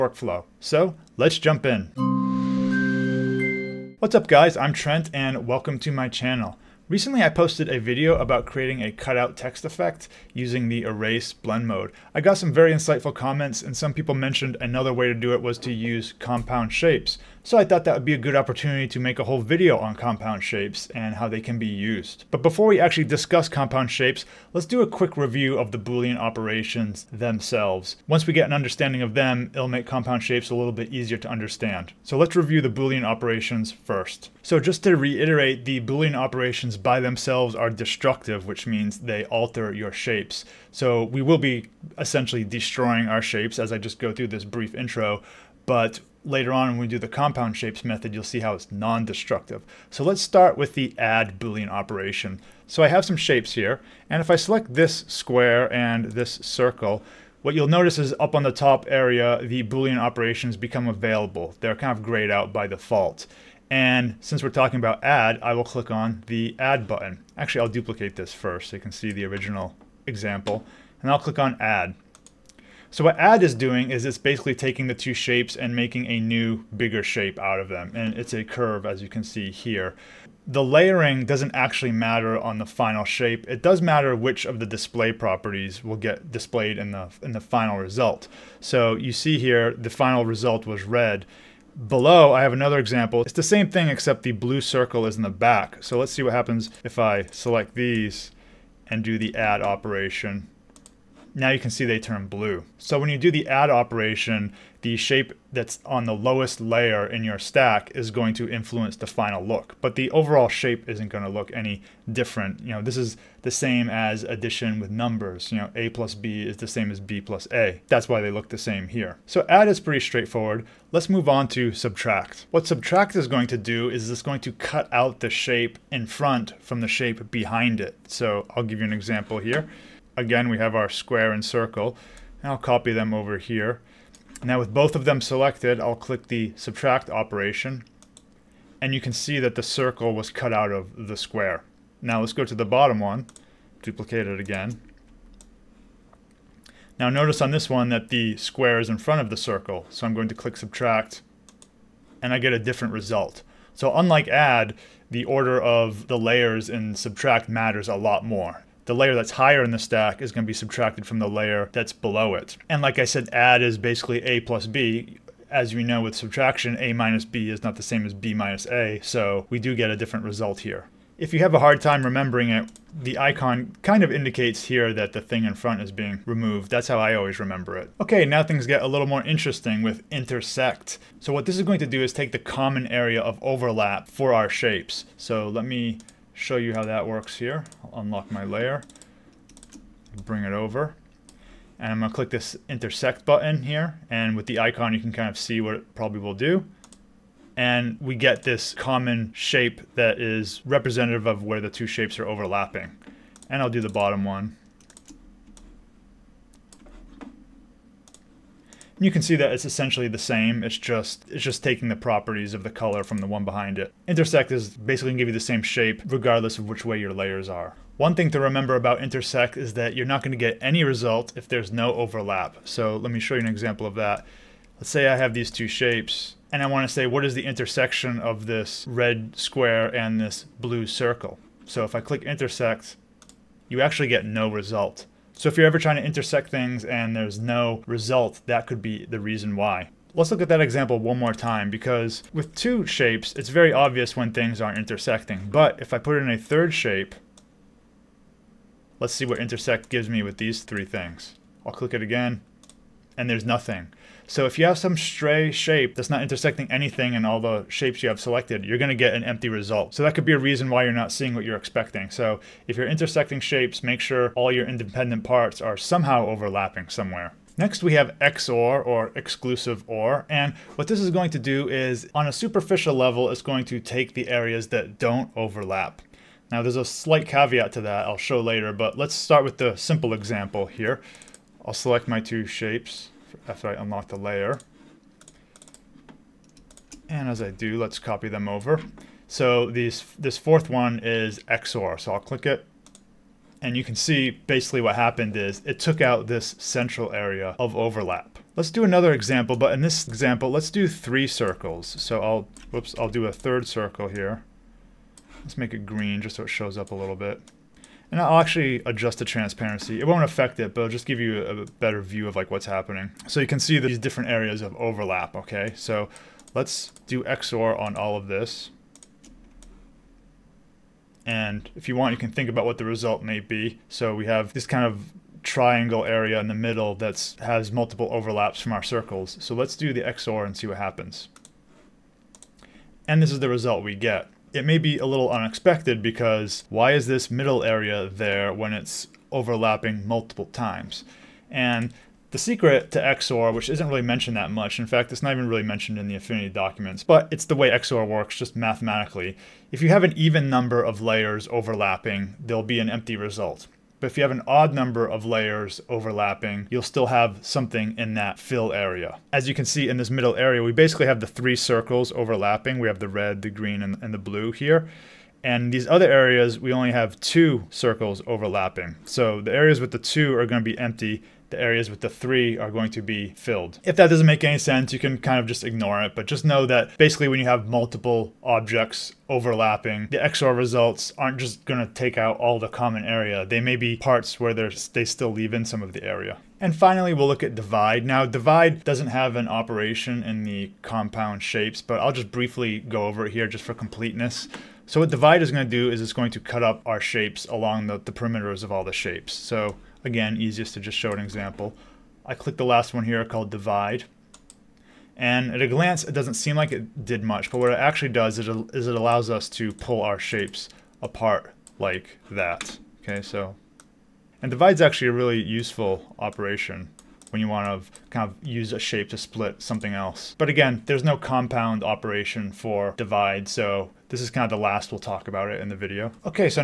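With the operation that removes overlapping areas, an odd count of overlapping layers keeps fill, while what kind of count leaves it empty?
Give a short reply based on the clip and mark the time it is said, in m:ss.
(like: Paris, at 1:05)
Even number, at 5:50.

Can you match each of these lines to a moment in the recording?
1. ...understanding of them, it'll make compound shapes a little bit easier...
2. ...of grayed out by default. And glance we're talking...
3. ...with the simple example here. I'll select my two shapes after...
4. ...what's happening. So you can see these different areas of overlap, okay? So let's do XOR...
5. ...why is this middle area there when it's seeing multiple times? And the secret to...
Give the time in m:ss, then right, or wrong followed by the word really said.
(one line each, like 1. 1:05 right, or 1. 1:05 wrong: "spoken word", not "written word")
1. 0:28 right
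2. 1:01 wrong: "since", not "glance"
3. 4:39 right
4. 5:12 right
5. 5:36 wrong: "overlapping", not "seeing".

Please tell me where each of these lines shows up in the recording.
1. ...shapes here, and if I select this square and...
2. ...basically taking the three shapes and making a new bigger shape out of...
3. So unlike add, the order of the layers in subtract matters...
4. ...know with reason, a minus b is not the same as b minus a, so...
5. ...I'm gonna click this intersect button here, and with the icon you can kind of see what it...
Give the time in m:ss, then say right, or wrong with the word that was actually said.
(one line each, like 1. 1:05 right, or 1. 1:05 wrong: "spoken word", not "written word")
1. 0:53 right
2. 1:14 wrong: "two", not "three"
3. 2:33 right
4. 2:45 wrong: "subtraction", not "reason"
5. 3:11 right.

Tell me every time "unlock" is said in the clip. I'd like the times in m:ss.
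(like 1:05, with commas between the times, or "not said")
3:08, 4:43.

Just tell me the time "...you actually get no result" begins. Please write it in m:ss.
3:53.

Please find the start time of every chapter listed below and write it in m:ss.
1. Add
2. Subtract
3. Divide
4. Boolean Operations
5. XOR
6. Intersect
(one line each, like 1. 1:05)
1. 0:50
2. 2:01
3. 6:25
4. 0:33
5. 4:26
6. 2:57.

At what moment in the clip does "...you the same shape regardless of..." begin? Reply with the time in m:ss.
3:35.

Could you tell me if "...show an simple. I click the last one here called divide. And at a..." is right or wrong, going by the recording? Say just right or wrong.
wrong.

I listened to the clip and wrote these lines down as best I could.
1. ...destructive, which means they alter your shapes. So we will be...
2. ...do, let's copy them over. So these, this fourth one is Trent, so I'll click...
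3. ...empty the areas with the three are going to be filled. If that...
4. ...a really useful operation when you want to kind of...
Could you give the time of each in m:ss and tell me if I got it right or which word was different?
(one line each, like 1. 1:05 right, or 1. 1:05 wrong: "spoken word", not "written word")
1. 0:37 right
2. 4:47 wrong: "XOR", not "Trent"
3. 6:10 right
4. 6:55 right.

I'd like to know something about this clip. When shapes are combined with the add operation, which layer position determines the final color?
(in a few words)
The lowest layer.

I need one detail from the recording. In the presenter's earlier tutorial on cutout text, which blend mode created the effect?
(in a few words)
Erase blend mode.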